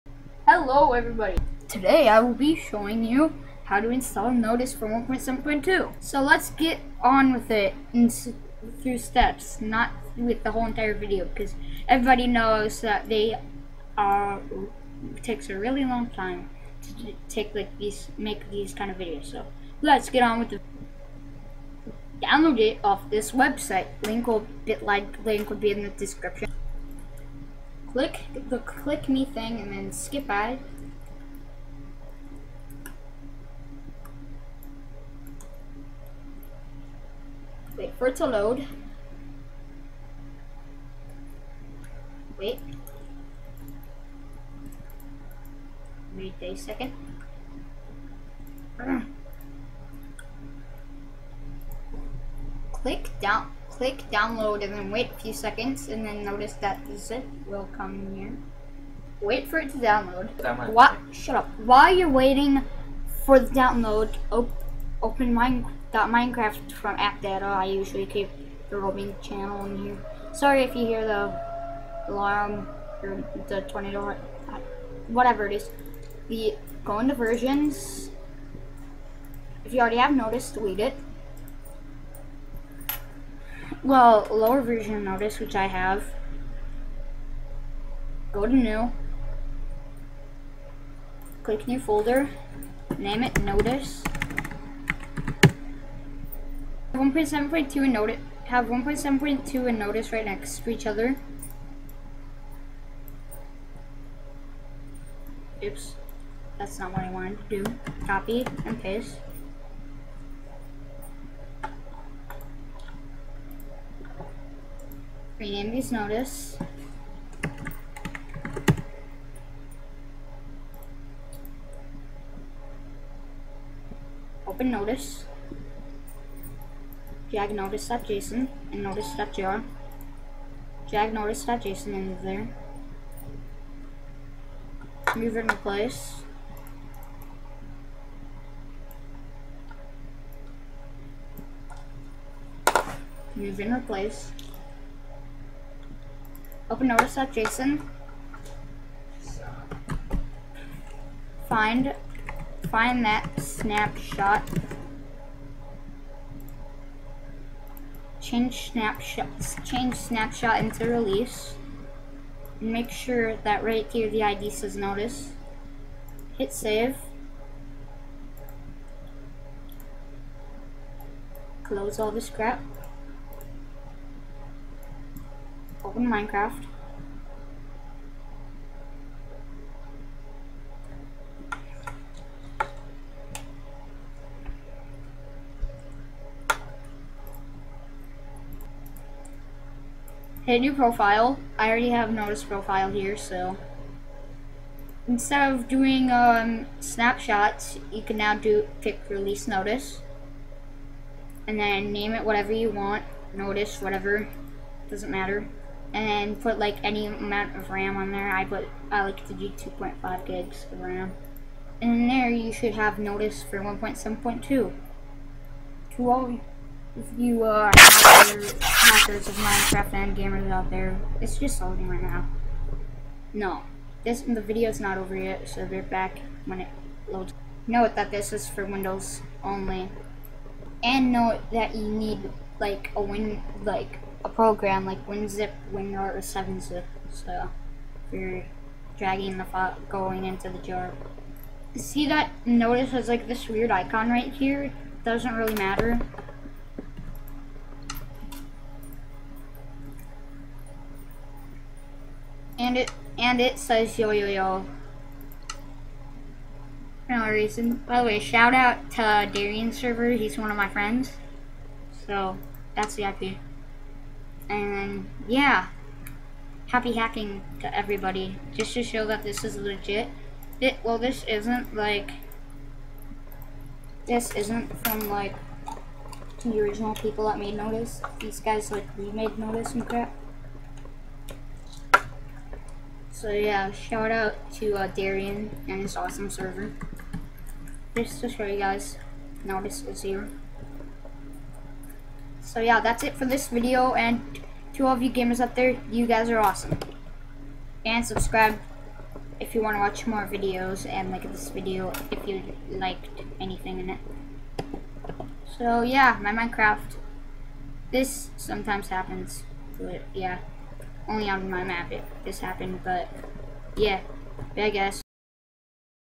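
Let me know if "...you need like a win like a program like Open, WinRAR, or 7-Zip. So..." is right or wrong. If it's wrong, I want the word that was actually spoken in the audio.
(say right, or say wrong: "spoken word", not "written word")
wrong: "WinZip", not "Open".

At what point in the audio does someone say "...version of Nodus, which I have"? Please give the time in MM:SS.
01:24.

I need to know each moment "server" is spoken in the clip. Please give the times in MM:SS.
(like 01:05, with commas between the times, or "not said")
04:19, 04:46.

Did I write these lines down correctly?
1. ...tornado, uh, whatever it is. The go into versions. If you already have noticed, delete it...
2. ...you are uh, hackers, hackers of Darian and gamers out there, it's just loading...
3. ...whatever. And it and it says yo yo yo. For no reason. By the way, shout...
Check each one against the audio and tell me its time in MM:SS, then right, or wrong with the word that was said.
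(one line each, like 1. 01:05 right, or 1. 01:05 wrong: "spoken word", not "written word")
1. 01:13 right
2. 03:37 wrong: "Minecraft", not "Darian"
3. 04:05 wrong: "matter", not "whatever".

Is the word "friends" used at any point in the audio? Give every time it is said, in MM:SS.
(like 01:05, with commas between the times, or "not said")
04:20.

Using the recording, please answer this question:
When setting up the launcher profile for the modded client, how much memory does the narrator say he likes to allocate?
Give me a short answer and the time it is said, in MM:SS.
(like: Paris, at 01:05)
2.5 gigs, at 03:29.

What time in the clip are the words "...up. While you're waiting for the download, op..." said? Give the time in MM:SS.
01:01.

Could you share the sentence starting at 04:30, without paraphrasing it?
It, well, this isn't like, this isn't from like the original people that made Nodus.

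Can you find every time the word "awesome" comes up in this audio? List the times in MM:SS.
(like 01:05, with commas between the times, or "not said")
04:45, 04:56.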